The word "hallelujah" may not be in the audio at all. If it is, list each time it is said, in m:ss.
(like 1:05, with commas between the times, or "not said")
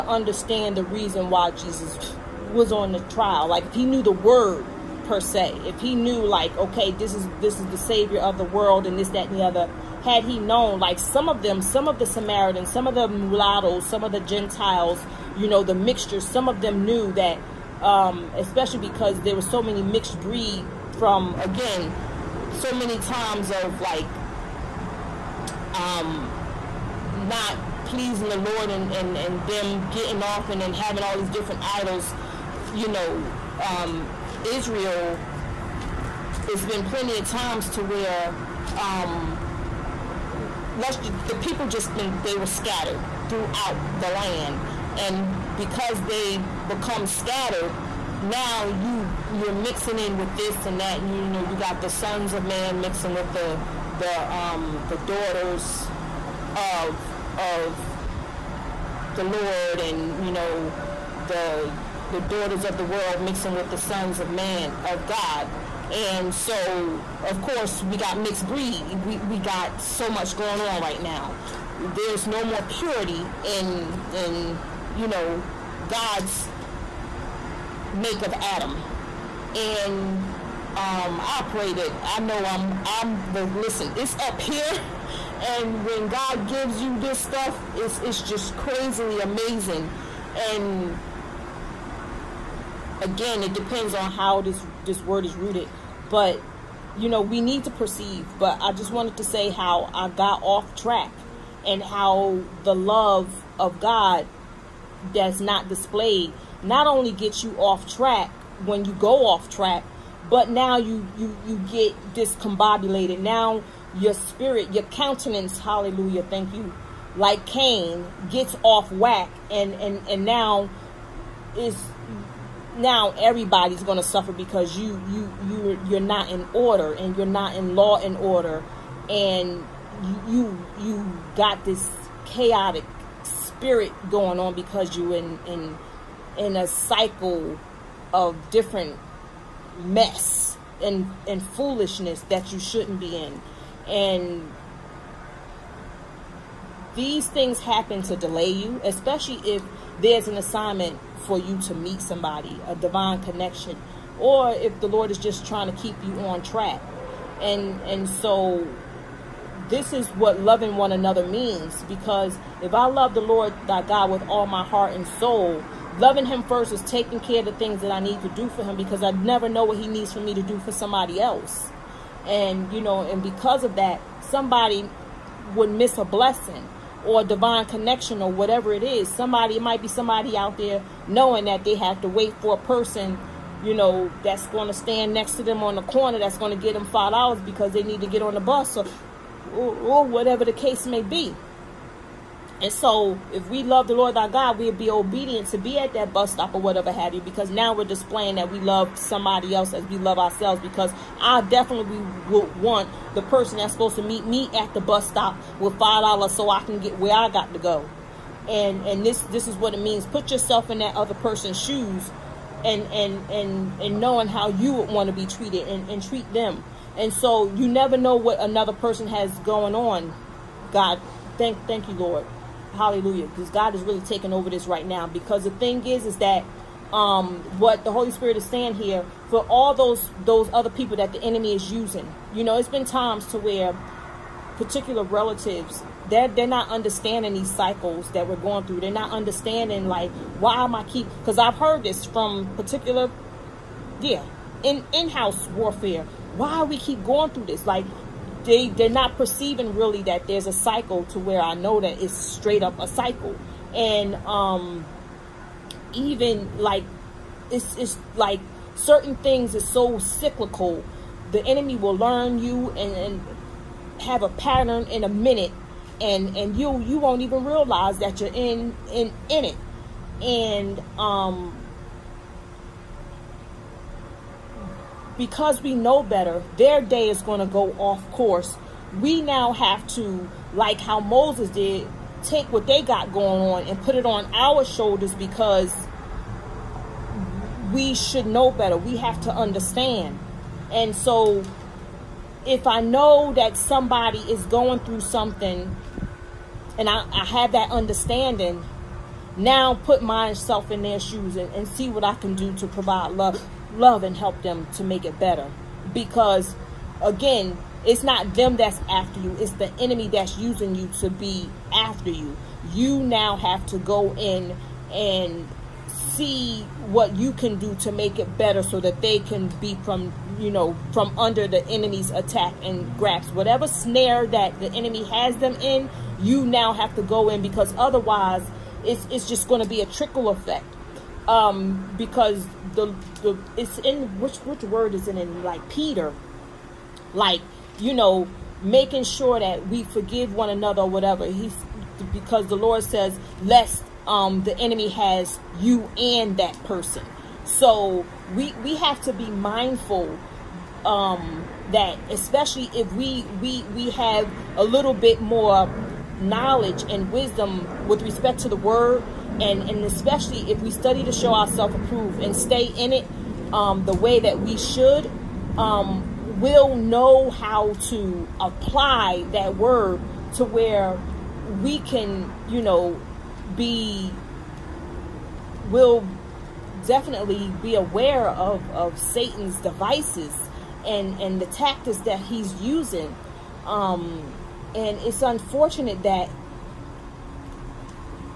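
1:55, 3:42.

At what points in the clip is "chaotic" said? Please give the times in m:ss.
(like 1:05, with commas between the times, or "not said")
2:12.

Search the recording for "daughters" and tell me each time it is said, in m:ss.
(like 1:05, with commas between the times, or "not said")
0:54, 1:02.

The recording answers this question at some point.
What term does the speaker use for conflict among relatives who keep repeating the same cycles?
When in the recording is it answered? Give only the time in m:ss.
4:04.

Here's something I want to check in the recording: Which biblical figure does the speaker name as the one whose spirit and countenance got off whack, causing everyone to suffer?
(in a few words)
Cain.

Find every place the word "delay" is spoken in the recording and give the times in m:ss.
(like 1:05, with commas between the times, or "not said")
2:28.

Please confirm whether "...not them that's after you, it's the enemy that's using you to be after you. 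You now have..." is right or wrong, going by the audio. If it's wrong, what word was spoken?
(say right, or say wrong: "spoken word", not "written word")
right.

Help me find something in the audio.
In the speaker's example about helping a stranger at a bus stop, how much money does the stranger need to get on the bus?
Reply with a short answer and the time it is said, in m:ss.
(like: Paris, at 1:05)
$5, at 3:06.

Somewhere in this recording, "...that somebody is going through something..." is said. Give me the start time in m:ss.
4:53.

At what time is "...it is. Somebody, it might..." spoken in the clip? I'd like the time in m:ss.
2:58.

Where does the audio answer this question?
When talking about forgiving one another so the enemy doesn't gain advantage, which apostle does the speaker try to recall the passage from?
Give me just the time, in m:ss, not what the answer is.
5:35.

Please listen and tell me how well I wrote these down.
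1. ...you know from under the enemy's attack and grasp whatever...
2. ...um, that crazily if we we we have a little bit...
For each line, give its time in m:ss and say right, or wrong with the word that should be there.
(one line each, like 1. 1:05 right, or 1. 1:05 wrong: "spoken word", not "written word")
1. 5:20 right
2. 5:50 wrong: "especially", not "crazily".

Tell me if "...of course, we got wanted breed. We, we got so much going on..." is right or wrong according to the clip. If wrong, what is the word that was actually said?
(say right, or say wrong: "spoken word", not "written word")
wrong: "mixed", not "wanted".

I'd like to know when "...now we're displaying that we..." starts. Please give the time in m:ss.
3:17.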